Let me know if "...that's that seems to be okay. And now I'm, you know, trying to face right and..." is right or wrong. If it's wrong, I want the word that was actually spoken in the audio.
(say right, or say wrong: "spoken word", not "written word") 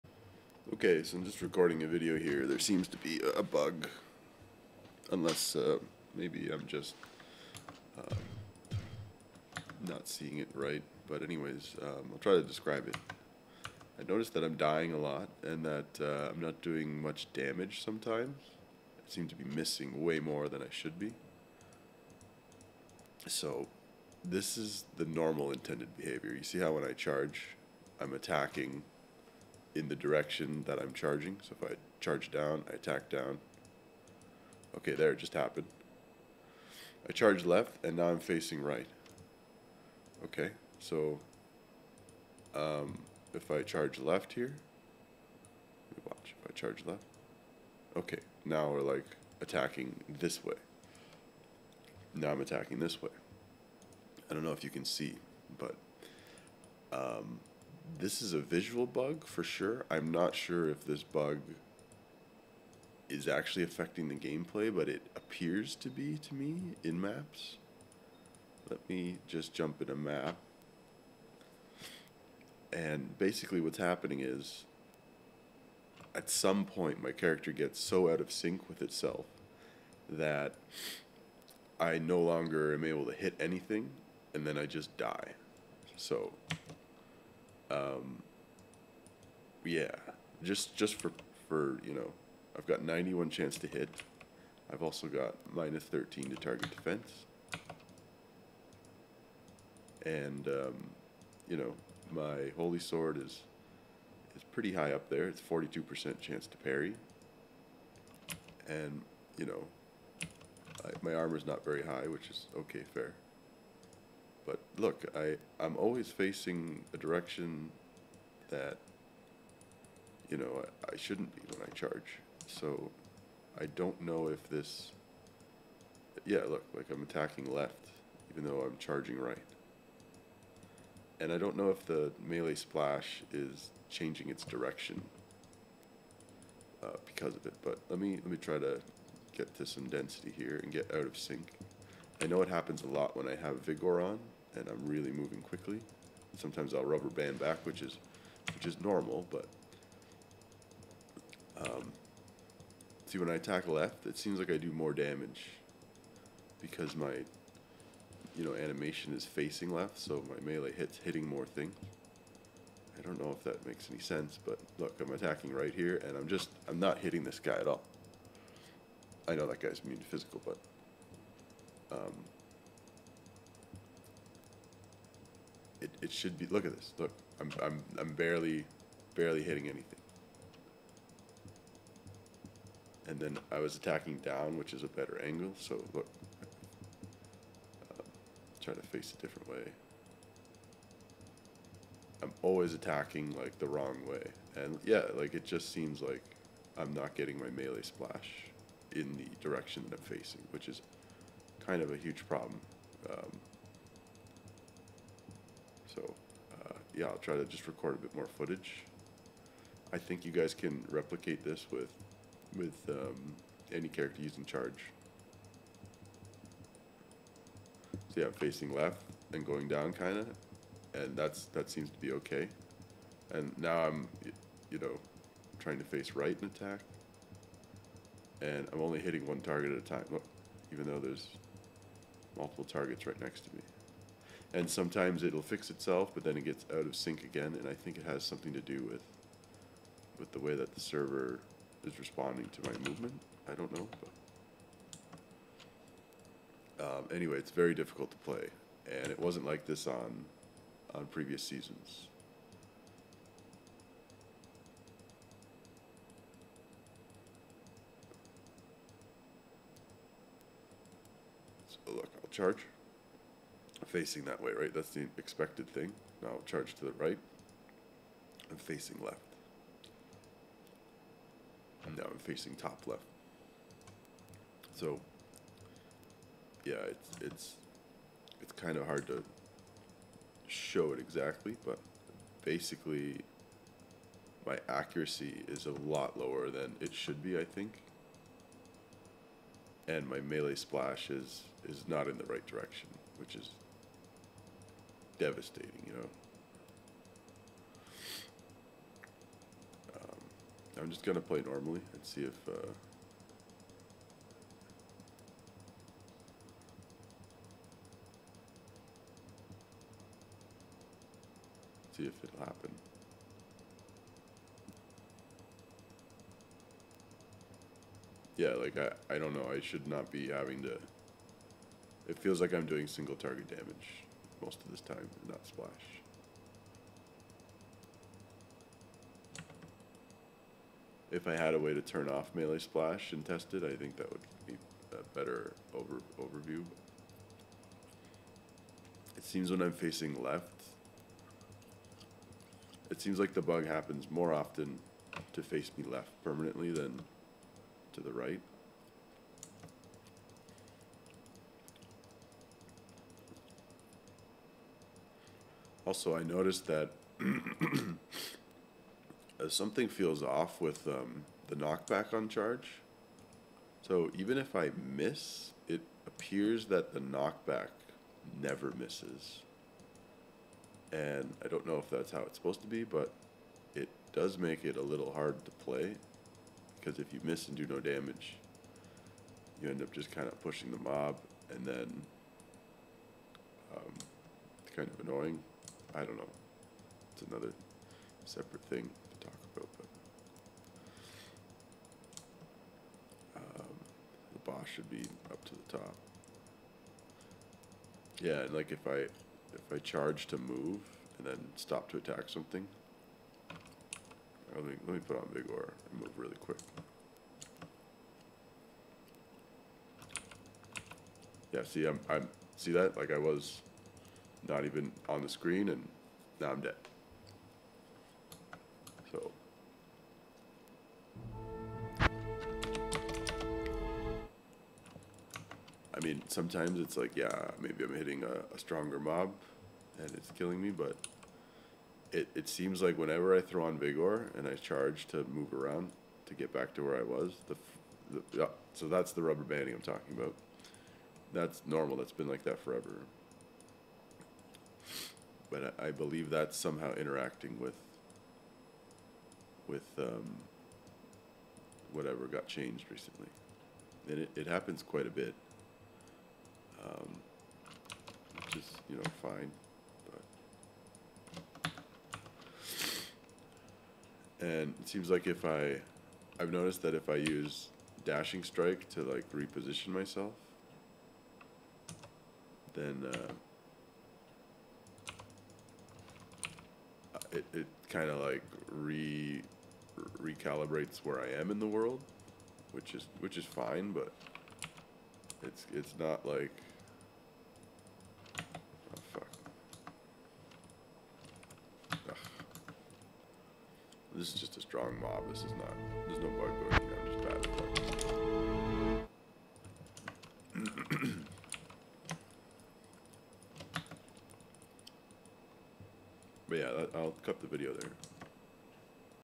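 right.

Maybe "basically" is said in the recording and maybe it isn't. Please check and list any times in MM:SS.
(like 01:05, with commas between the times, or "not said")
01:13, 04:42.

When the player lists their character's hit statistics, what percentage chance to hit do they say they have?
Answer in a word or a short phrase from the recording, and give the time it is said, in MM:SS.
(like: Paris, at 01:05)
91, at 01:32.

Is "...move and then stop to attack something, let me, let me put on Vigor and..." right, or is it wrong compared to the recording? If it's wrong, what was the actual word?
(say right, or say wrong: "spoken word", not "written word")
right.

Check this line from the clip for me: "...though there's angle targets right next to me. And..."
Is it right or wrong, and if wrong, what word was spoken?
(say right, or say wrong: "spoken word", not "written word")
wrong: "multiple", not "angle".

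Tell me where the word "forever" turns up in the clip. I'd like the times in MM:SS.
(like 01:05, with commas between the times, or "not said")
07:22.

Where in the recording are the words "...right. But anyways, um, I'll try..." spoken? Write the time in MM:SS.
00:10.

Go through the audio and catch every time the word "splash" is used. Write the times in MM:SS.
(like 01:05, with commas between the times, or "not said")
02:12, 03:17, 04:50, 05:25, 05:32.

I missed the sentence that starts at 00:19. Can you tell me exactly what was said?
I seem to be missing way more than I should be.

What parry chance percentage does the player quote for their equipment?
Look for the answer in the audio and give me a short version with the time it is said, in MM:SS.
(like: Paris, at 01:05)
42%, at 01:45.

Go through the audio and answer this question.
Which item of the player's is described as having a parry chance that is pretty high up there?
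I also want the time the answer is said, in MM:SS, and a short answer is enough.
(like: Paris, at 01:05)
holy sword, at 01:42.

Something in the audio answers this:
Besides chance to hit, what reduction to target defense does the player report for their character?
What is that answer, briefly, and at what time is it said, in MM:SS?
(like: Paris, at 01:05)
minus 13, at 01:35.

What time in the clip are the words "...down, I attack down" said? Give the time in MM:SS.
00:32.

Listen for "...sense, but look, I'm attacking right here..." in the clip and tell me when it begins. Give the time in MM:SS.
02:43.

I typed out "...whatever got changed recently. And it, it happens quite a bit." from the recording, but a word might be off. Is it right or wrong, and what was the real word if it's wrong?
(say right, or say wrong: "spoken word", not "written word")
right.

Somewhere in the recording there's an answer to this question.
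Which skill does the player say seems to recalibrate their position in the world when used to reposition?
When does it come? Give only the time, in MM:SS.
07:48.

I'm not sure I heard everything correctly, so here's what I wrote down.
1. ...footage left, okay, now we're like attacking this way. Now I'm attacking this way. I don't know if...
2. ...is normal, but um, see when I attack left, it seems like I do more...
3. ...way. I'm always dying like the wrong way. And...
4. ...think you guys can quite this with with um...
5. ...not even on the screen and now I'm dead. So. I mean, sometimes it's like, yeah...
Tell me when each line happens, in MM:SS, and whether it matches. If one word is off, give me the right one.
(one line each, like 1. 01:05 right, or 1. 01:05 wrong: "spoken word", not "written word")
1. 00:46 wrong: "charge", not "footage"
2. 02:28 right
3. 03:09 wrong: "attacking", not "dying"
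4. 03:29 wrong: "replicate", not "quite"
5. 06:54 right.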